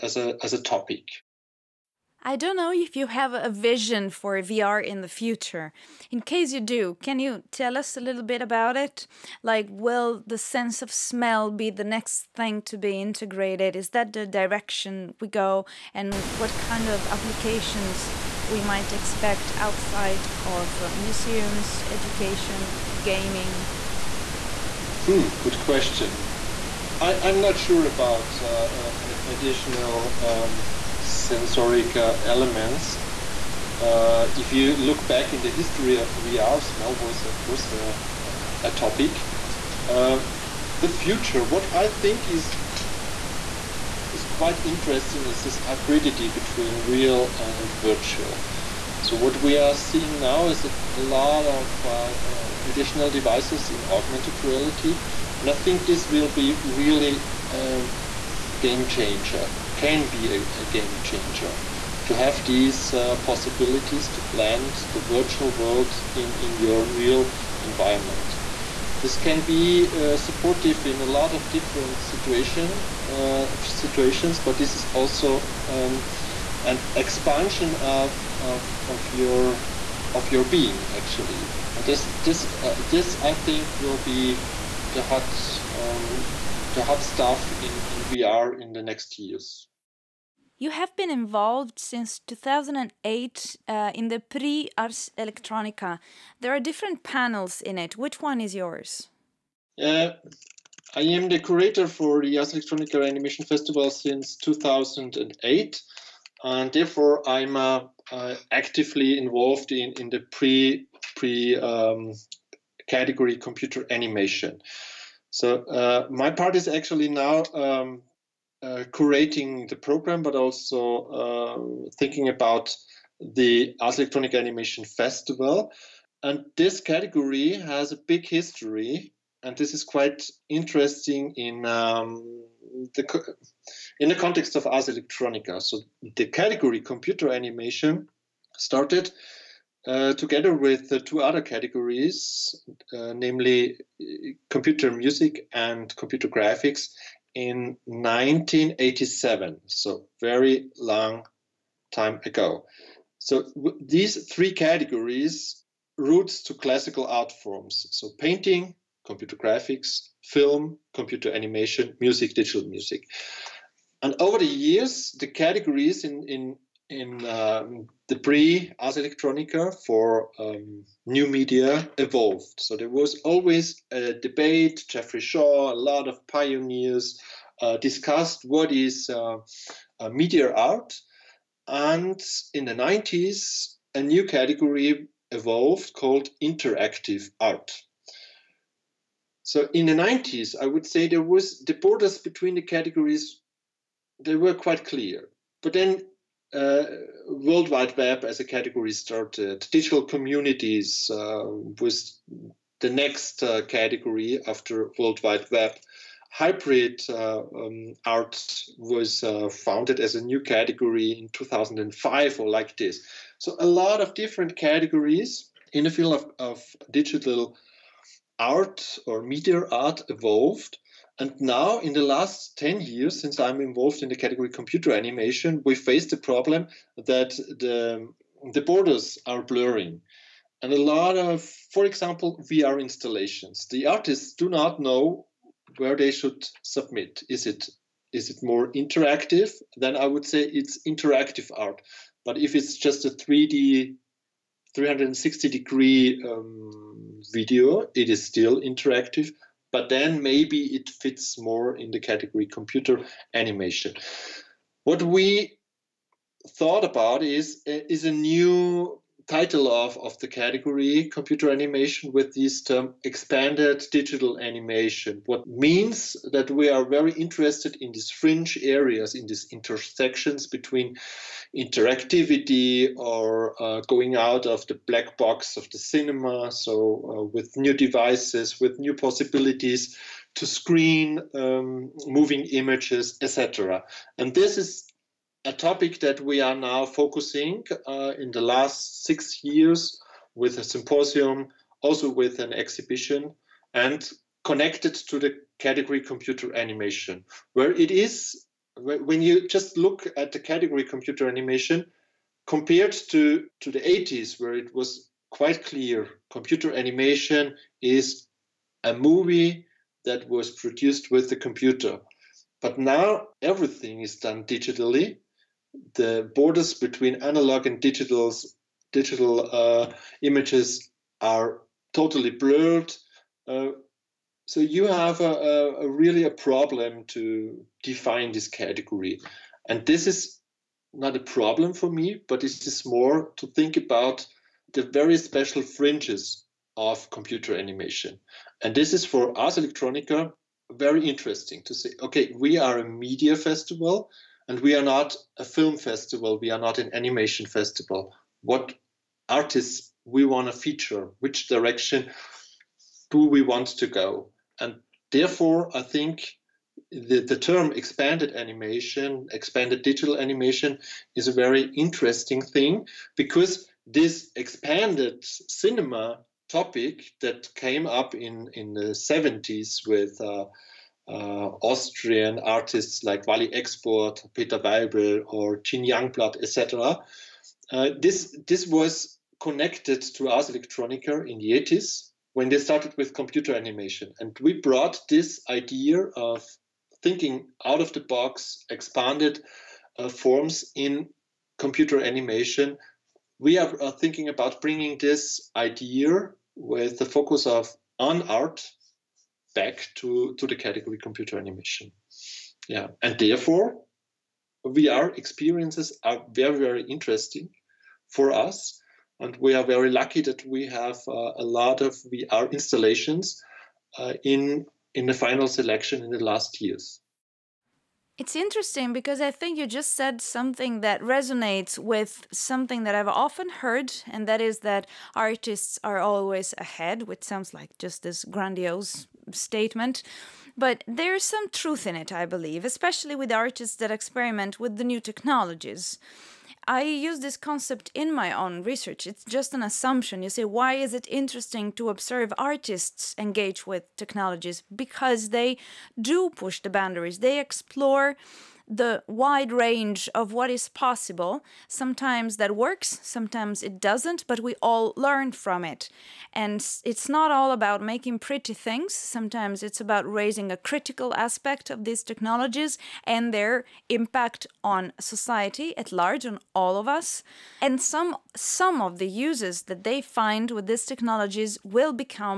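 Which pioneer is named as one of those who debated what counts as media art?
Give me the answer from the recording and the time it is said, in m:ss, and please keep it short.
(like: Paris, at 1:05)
Jeffrey Shaw, at 2:54.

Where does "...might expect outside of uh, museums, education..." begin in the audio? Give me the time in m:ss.
0:18.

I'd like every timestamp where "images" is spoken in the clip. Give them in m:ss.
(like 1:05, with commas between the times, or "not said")
4:42, 5:20.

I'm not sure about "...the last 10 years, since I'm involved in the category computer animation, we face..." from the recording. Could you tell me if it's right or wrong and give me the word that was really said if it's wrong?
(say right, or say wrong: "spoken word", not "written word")
right.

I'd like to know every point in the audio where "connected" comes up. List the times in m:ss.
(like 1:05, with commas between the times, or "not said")
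4:54, 6:19.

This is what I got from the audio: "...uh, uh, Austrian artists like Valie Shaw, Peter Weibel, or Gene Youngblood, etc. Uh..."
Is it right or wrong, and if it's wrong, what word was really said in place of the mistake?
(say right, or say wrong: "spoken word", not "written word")
wrong: "Export", not "Shaw".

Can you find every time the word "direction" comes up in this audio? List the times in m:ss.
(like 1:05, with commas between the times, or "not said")
0:14, 5:51.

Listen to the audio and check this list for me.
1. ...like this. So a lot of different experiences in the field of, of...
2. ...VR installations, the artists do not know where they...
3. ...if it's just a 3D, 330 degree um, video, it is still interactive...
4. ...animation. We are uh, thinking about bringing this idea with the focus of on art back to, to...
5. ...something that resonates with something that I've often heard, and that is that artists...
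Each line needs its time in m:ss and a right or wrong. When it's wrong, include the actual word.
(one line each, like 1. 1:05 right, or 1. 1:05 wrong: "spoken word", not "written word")
1. 3:32 wrong: "categories", not "experiences"
2. 3:52 right
3. 4:02 wrong: "360", not "330"
4. 6:32 right
5. 7:00 right.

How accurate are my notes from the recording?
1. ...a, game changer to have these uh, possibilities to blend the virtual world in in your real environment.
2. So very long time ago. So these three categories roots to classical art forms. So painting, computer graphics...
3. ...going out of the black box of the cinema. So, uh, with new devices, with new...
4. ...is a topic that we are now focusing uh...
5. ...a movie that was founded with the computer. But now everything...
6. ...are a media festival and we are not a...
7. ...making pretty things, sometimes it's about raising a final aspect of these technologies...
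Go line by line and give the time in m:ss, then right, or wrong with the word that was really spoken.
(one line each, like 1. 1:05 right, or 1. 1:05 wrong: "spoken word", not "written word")
1. 1:00 right
2. 2:29 right
3. 4:33 right
4. 4:44 right
5. 5:08 wrong: "produced", not "founded"
6. 5:42 right
7. 7:37 wrong: "critical", not "final".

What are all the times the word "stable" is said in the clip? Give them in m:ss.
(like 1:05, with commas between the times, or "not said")
not said.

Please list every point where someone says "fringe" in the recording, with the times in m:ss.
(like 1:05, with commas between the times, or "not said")
4:28, 5:35.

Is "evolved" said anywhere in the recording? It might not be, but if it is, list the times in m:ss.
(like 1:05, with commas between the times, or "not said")
2:51, 3:05, 3:40.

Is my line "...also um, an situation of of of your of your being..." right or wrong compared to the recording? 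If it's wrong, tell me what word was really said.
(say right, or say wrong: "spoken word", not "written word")
wrong: "expansion", not "situation".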